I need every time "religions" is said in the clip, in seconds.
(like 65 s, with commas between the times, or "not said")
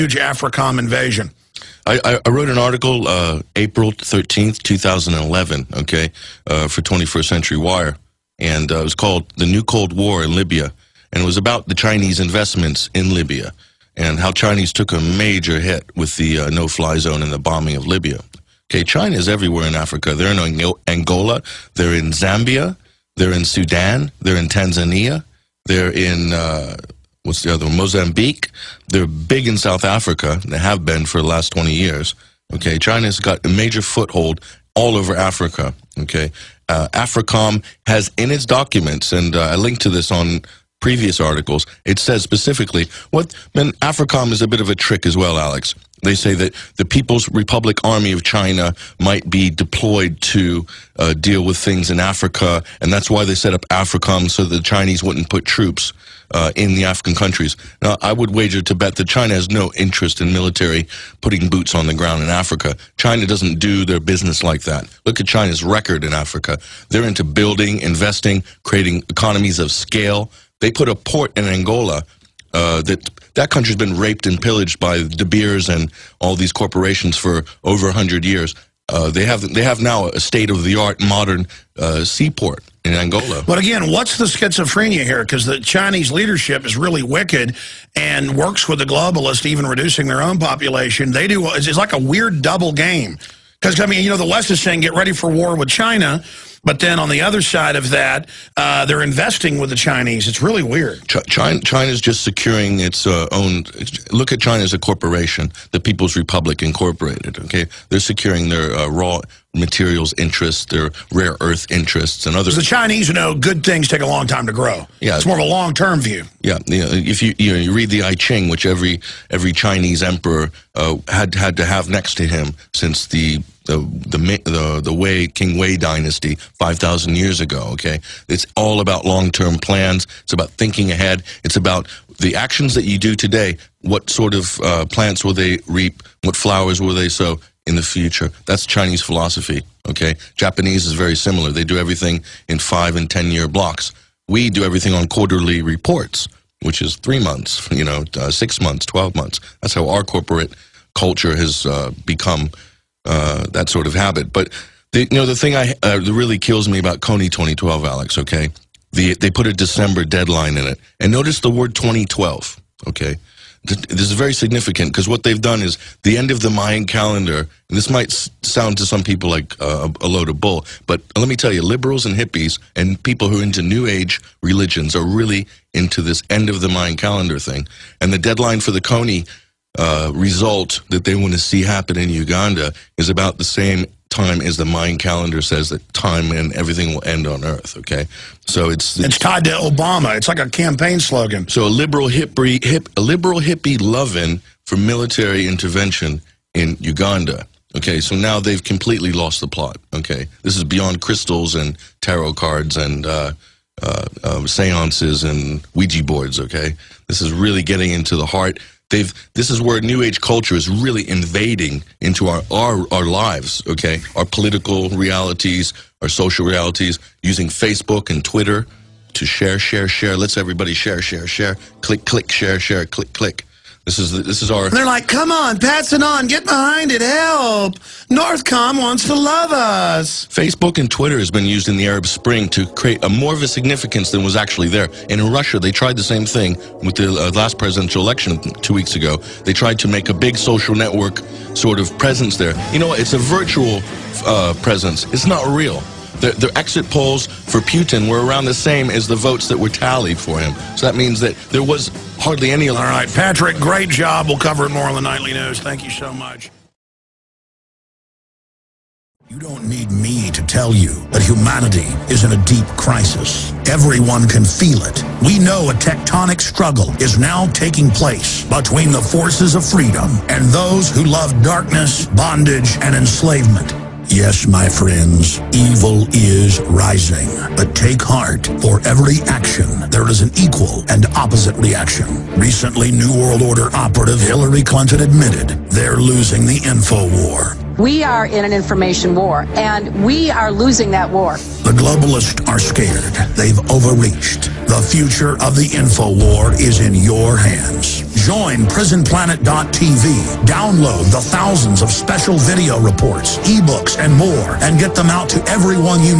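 174 s.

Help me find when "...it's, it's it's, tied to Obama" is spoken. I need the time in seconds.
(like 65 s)
188 s.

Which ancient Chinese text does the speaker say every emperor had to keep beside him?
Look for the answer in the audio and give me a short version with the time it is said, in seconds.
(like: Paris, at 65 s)
I Ching, at 118 s.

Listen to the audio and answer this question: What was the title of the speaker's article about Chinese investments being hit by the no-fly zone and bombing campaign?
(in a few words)
The New Cold War in Libya.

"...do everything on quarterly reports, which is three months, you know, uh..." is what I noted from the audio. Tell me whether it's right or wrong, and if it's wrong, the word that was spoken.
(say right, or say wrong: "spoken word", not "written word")
right.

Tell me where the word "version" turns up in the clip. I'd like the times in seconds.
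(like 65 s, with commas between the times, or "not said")
not said.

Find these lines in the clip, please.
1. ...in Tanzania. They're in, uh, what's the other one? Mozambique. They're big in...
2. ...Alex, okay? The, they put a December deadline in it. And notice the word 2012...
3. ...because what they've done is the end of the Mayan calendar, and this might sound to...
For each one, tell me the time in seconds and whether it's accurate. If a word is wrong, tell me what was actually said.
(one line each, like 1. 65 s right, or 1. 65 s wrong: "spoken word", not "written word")
1. 24 s right
2. 157 s right
3. 164 s right.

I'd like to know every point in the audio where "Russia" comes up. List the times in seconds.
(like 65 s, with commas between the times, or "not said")
235 s.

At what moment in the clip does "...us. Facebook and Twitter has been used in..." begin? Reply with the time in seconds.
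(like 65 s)
229 s.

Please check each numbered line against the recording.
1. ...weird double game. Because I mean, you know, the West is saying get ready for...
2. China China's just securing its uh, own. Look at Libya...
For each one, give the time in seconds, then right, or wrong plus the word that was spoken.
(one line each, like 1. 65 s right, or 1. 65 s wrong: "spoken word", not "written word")
1. 91 s right
2. 101 s wrong: "China", not "Libya".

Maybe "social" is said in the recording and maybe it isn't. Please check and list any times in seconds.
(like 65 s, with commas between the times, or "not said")
216 s, 240 s.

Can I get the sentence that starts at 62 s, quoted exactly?
China doesn't do their business like that.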